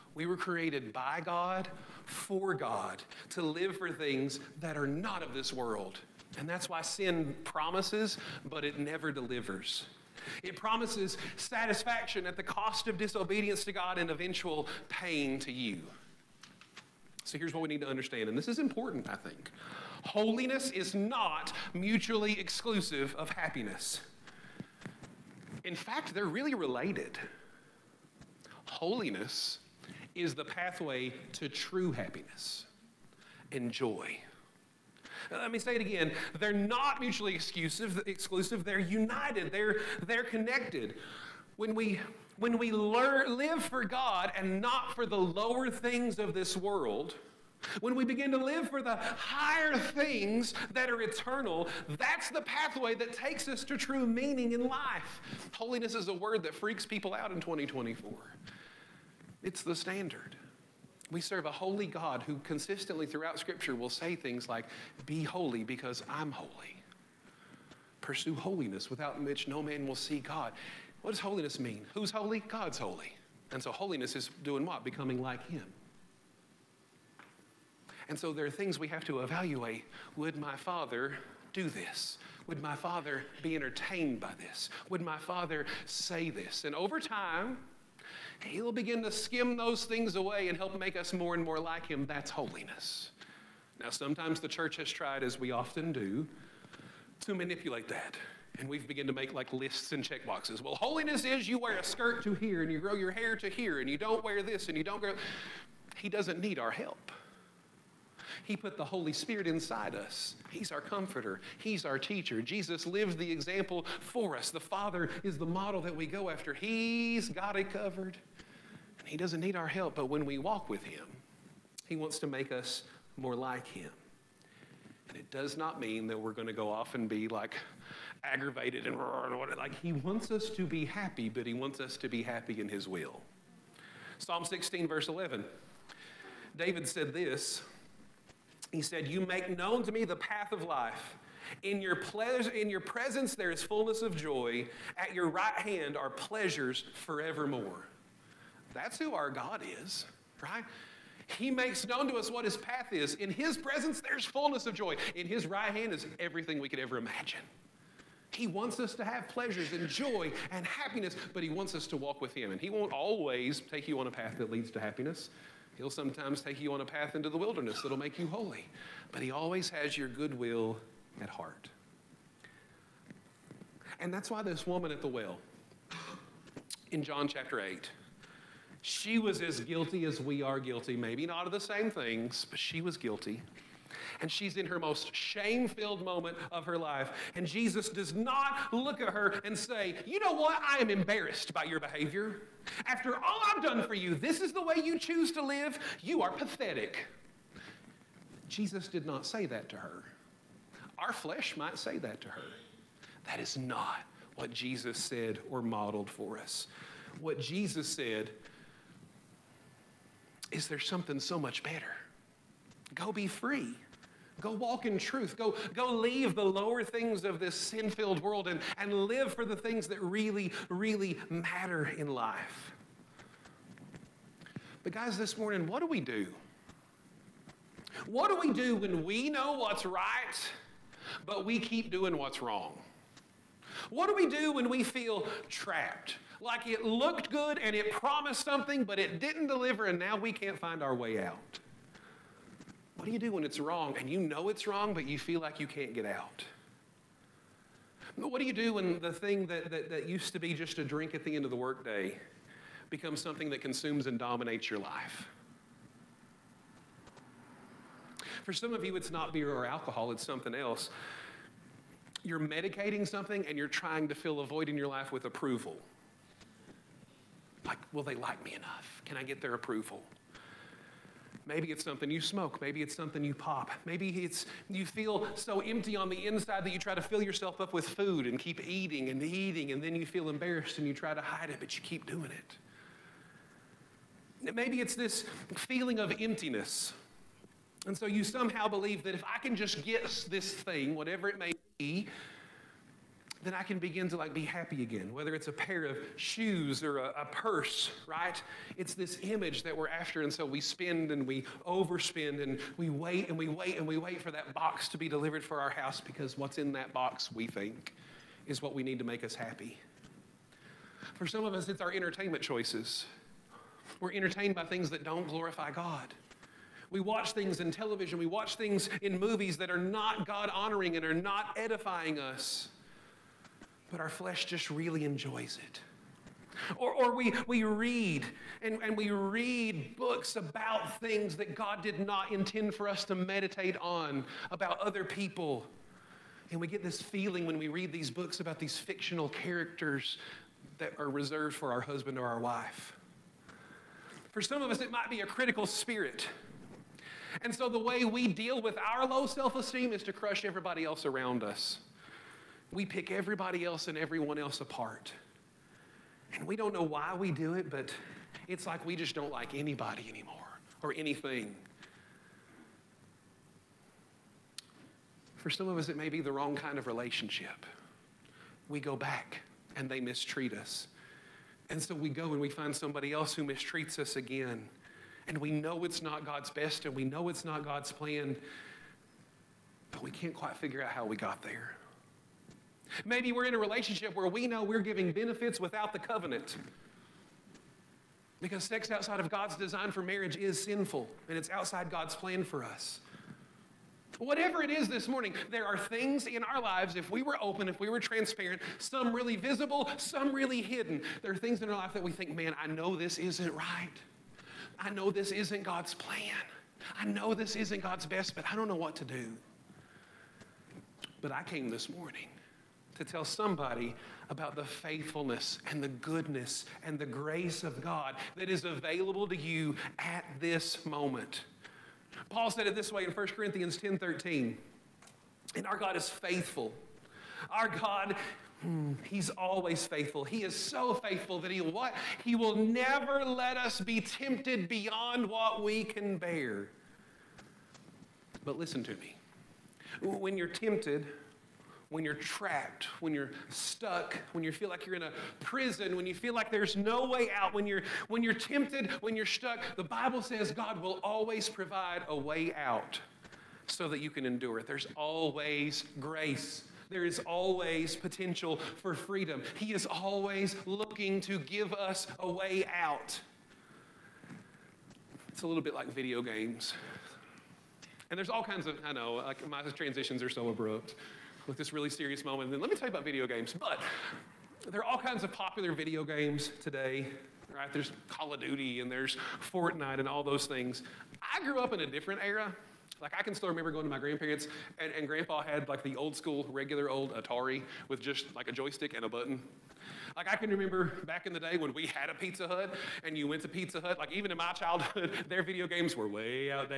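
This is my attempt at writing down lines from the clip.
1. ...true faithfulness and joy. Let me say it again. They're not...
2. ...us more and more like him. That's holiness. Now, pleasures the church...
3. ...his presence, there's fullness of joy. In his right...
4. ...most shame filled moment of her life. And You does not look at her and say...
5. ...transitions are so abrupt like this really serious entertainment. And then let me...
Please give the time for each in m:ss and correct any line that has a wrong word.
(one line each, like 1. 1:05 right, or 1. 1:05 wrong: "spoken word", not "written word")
1. 0:31 wrong: "happiness", not "faithfulness"
2. 1:30 wrong: "sometimes", not "pleasures"
3. 2:33 right
4. 3:04 wrong: "Jesus", not "You"
5. 7:49 wrong: "moment", not "entertainment".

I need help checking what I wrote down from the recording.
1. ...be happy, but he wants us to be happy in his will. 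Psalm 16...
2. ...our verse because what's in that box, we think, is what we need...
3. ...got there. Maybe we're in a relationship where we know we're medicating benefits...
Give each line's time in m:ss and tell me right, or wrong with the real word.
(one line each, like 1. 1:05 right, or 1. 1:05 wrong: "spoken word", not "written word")
1. 2:10 right
2. 5:05 wrong: "house", not "verse"
3. 6:21 wrong: "giving", not "medicating".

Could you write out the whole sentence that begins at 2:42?
And He won't always take you on a path that leads to happiness.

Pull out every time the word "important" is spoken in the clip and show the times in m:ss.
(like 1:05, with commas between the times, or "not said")
0:18.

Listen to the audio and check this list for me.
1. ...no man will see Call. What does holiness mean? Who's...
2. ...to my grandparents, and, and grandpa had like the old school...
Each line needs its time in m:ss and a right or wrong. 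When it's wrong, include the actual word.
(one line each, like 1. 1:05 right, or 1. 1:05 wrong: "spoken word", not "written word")
1. 1:09 wrong: "God", not "Call"
2. 8:03 right.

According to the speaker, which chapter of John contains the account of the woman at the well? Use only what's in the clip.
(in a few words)
John 8.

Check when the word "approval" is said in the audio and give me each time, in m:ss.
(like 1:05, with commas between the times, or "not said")
4:25, 4:29.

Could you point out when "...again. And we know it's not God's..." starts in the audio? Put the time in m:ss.
6:14.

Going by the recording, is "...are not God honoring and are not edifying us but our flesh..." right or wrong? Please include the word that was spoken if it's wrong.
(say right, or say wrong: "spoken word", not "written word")
right.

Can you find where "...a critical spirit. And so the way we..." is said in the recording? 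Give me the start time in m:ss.
5:45.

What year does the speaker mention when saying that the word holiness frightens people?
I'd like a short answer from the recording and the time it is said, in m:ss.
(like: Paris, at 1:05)
2024, at 0:57.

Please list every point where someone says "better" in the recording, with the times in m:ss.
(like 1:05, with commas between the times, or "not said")
3:31.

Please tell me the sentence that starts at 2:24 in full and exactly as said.
At your right hand are pleasures forevermore.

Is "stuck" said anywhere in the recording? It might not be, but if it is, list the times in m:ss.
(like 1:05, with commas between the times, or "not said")
7:23, 7:29.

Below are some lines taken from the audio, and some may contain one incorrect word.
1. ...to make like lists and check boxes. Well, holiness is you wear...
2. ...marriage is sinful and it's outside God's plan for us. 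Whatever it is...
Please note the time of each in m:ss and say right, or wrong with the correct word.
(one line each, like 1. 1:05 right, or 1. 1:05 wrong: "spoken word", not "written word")
1. 1:39 right
2. 6:30 right.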